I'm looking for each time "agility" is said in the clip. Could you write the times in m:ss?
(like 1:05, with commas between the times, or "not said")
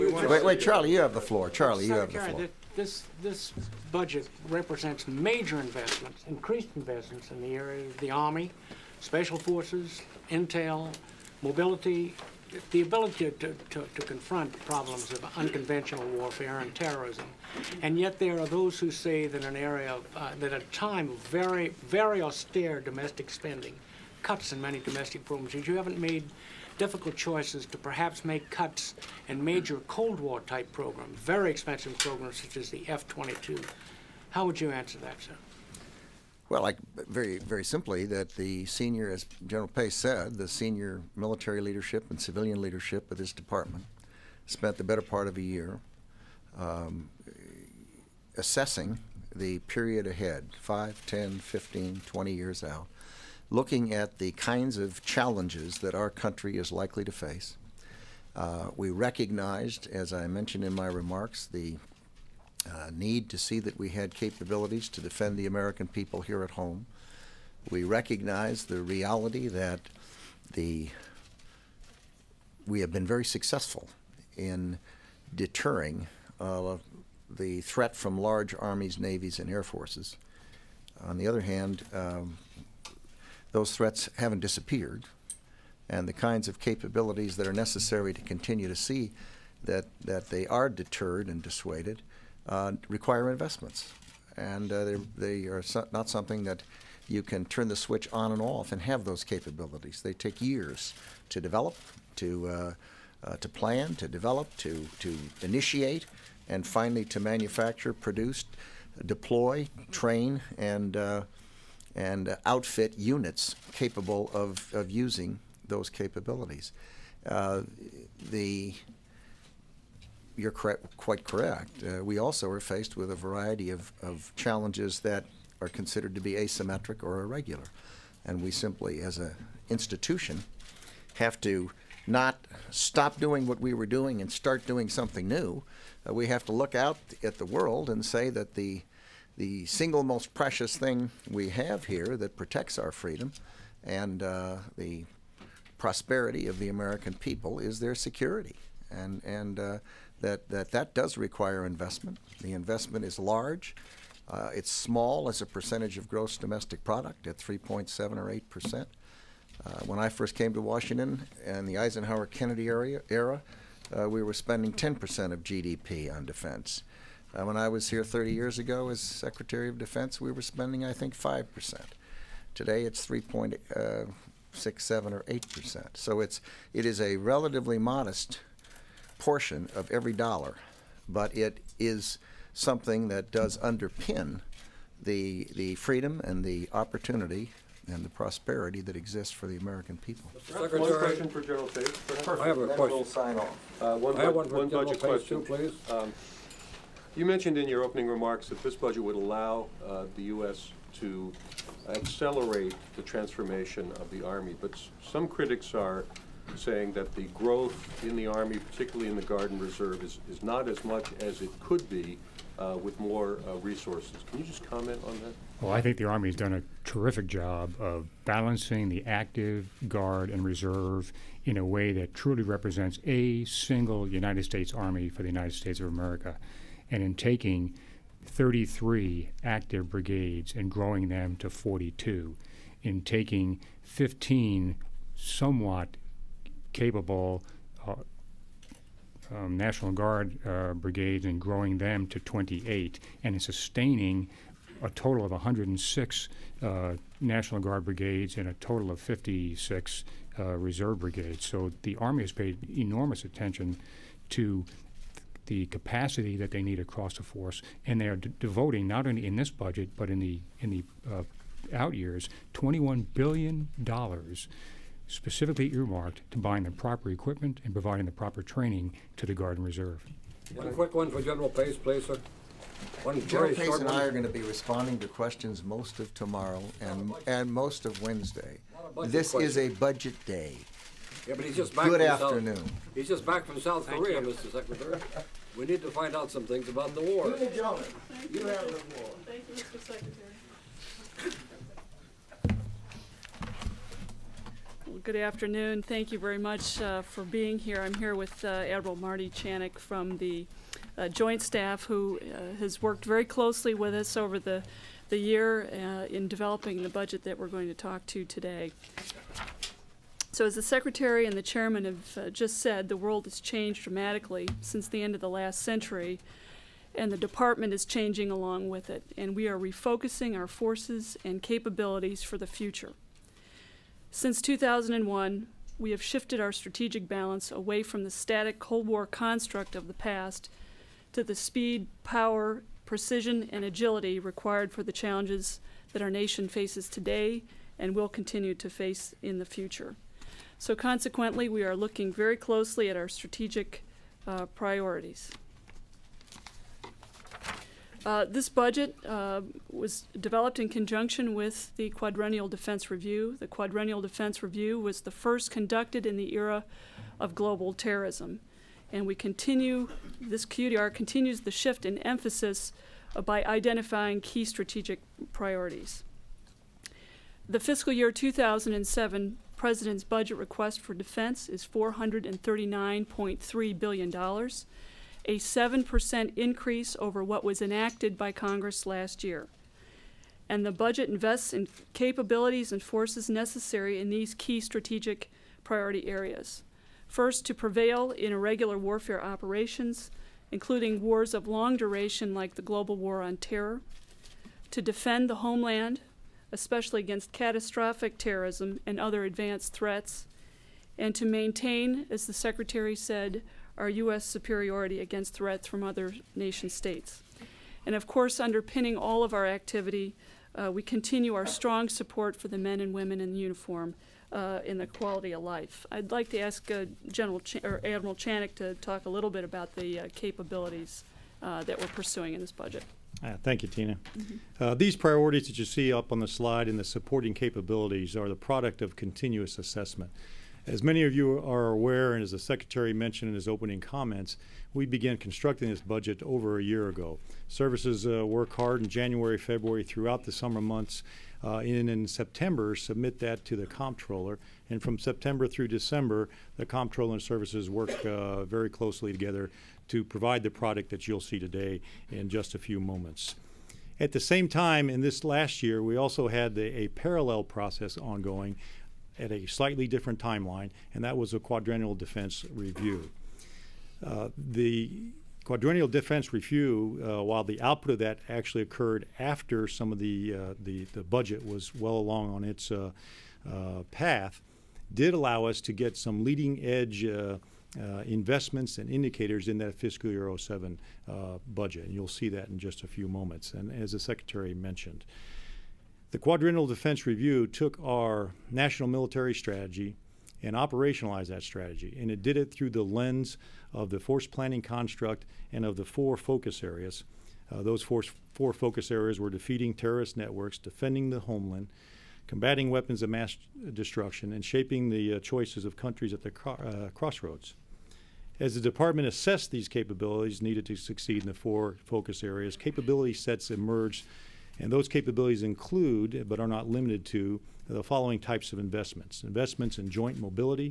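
5:33.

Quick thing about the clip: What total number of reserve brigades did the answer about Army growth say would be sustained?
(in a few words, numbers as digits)
56.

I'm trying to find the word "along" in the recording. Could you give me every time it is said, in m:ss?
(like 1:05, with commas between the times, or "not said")
5:18, 7:51.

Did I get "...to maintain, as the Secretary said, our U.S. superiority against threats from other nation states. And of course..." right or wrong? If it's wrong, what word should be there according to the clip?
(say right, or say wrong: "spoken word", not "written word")
right.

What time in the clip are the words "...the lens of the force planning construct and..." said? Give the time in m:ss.
8:12.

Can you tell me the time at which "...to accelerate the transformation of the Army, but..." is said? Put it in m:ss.
3:20.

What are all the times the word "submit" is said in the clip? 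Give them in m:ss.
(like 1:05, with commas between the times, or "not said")
7:22.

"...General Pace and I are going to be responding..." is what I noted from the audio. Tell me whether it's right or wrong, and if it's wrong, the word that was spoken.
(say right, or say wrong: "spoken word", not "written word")
right.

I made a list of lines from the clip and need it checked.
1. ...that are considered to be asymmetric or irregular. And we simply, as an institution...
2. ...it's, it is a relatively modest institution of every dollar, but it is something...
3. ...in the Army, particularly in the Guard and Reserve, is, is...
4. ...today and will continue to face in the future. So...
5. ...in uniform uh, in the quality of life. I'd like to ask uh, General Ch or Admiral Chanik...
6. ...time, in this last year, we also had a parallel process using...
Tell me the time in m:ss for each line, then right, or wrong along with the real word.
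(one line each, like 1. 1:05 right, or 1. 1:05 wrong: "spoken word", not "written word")
1. 2:05 right
2. 2:56 wrong: "portion", not "institution"
3. 3:28 right
4. 5:36 right
5. 6:53 right
6. 7:34 wrong: "ongoing", not "using".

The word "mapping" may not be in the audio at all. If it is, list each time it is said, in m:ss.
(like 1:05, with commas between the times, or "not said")
not said.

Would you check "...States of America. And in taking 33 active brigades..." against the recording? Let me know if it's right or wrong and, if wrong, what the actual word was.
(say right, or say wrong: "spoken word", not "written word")
right.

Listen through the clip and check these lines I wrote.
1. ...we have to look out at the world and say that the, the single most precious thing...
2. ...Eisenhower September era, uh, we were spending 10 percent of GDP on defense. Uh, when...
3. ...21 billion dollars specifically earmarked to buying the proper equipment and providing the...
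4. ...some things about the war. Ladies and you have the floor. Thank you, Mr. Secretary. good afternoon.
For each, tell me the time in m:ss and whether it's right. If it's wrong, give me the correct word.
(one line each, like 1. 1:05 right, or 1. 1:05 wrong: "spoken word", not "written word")
1. 2:16 right
2. 2:41 wrong: "Kennedy", not "September"
3. 4:22 right
4. 4:46 right.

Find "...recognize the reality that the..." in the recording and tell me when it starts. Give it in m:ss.
1:07.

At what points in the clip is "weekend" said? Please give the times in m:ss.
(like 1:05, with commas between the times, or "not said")
not said.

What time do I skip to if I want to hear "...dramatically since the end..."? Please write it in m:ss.
5:13.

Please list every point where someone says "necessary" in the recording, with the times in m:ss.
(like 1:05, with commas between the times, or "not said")
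1:27, 6:23.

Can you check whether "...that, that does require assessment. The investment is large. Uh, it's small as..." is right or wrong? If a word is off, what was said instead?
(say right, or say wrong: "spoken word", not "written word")
wrong: "investment", not "assessment".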